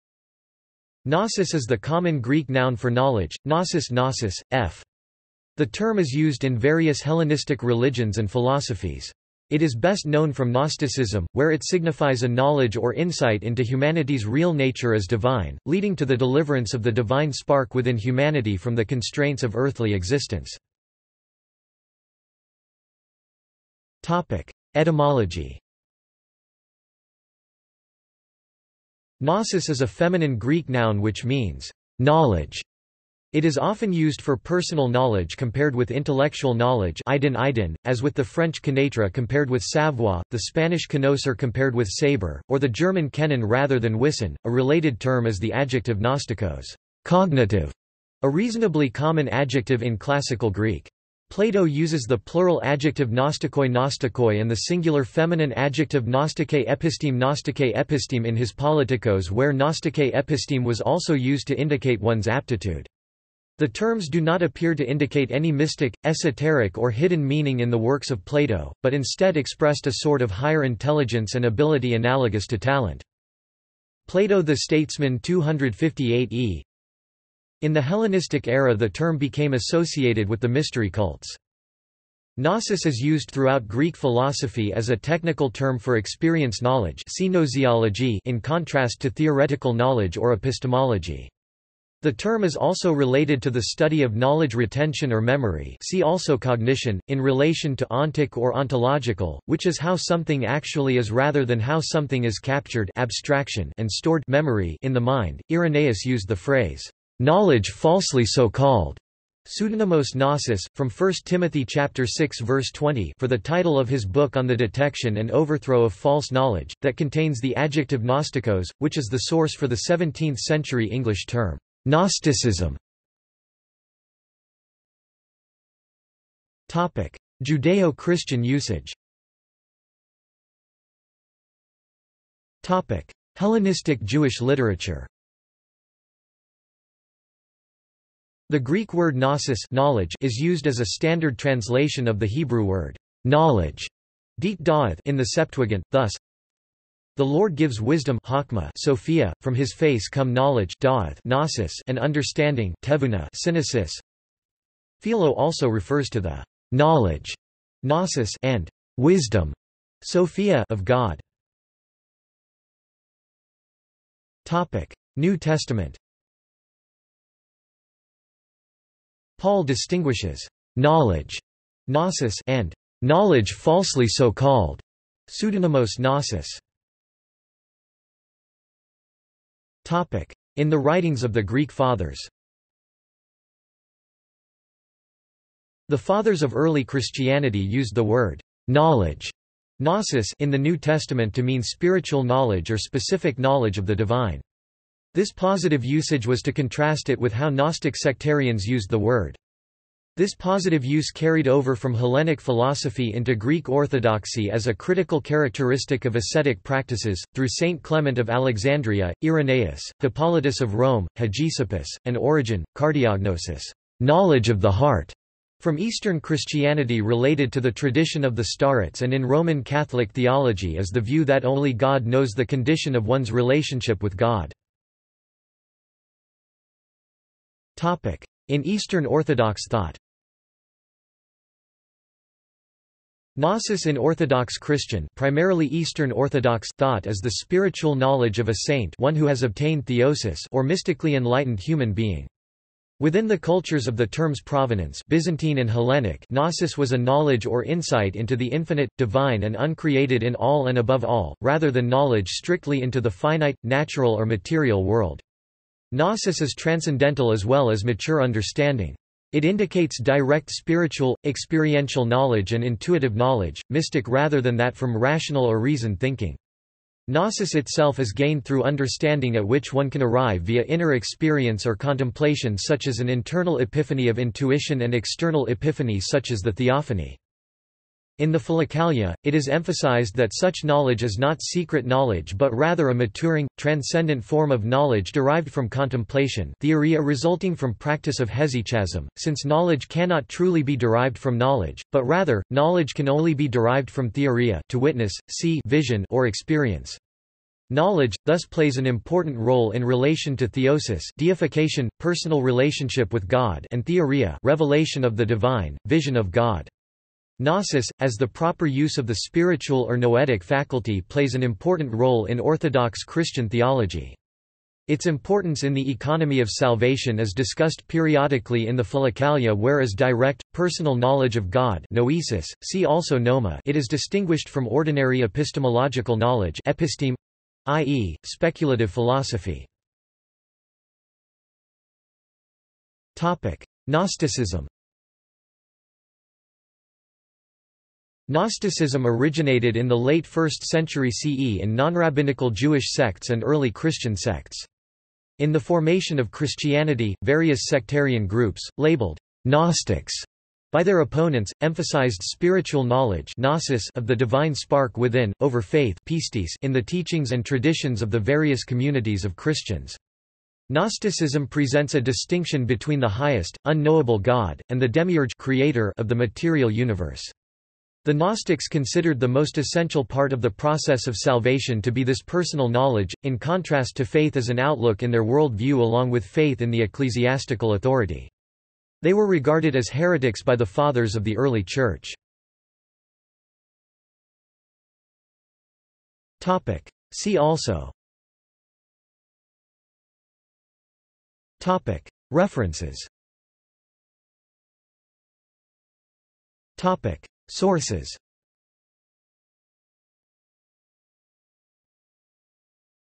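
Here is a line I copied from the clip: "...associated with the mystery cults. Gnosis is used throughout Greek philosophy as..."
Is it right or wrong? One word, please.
right.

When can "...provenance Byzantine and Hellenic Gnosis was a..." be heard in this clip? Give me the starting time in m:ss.
4:04.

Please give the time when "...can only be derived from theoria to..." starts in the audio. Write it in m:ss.
4:52.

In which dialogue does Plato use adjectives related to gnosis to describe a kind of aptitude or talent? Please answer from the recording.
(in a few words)
Politikos.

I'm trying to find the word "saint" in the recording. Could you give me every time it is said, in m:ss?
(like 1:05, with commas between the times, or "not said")
3:27, 3:58.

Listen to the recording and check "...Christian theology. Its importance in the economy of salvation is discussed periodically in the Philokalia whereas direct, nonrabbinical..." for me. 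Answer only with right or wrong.
wrong.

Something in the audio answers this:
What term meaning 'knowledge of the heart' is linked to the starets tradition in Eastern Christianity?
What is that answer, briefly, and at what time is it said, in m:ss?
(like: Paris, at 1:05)
cardiognosis, at 3:32.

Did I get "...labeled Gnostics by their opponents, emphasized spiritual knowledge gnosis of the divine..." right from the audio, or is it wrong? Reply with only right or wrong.
right.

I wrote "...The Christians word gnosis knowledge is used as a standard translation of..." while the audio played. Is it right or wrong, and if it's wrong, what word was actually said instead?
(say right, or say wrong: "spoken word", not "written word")
wrong: "Greek", not "Christians".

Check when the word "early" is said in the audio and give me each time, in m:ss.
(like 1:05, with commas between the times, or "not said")
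3:06, 5:43, 6:21.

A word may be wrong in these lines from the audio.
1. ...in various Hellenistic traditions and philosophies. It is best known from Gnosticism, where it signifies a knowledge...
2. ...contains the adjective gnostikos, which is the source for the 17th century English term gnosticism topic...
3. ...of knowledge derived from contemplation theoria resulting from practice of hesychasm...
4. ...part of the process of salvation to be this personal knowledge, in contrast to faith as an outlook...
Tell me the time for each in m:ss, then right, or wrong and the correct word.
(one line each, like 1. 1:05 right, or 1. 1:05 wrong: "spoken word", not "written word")
1. 0:06 wrong: "religions", not "traditions"
2. 1:56 right
3. 4:44 right
4. 6:10 right.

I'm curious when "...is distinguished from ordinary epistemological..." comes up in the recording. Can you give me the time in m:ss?
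5:23.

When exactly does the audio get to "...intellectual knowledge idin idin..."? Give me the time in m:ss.
0:35.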